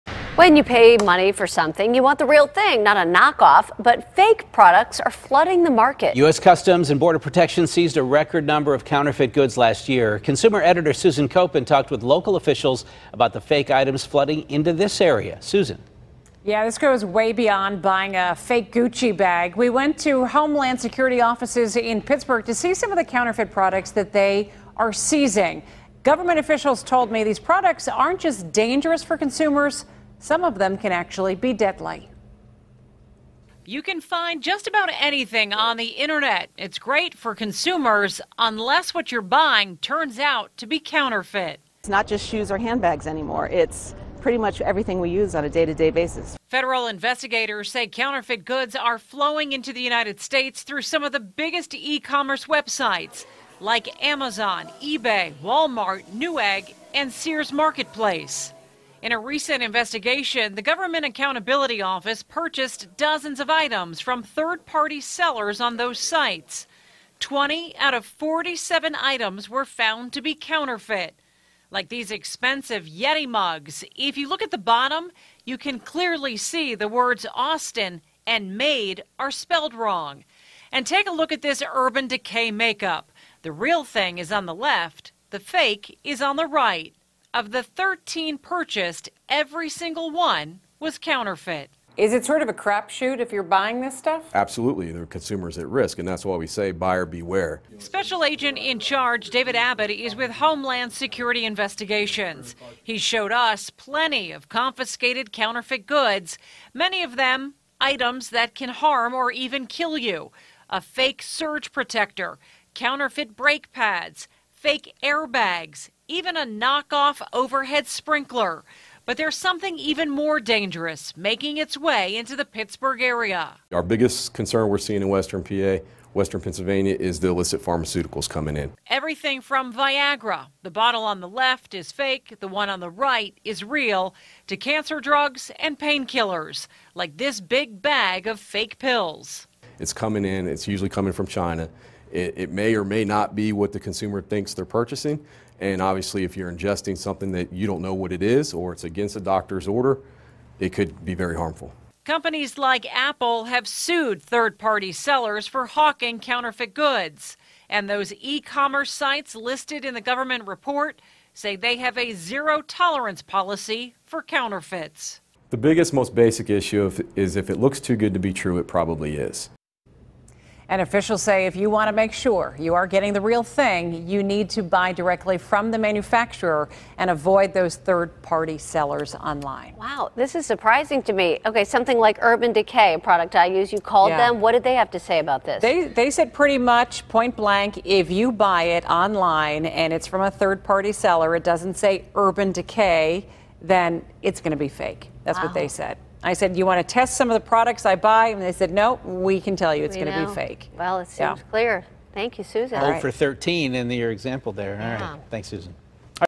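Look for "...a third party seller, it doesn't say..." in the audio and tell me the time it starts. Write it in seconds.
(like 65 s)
190 s.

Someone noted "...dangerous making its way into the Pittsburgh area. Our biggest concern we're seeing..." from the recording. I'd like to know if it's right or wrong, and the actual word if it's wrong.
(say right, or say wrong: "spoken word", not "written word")
right.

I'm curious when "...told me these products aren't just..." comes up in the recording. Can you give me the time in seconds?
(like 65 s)
26 s.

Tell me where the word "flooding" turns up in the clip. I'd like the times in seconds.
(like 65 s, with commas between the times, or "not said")
5 s, 14 s.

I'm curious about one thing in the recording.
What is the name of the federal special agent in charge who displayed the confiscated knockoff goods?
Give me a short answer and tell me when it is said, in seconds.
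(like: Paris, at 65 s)
David Abbott, at 99 s.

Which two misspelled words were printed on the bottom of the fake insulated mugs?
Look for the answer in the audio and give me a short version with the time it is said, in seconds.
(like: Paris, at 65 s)
Austin and made, at 77 s.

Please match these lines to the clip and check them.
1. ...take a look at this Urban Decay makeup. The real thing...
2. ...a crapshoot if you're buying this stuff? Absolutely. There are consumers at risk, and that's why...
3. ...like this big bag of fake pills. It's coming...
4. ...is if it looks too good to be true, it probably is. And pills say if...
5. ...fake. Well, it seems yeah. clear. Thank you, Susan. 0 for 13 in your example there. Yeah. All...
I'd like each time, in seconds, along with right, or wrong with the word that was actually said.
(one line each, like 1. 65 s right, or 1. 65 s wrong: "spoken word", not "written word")
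1. 80 s right
2. 92 s right
3. 136 s right
4. 167 s wrong: "officials", not "pills"
5. 200 s right.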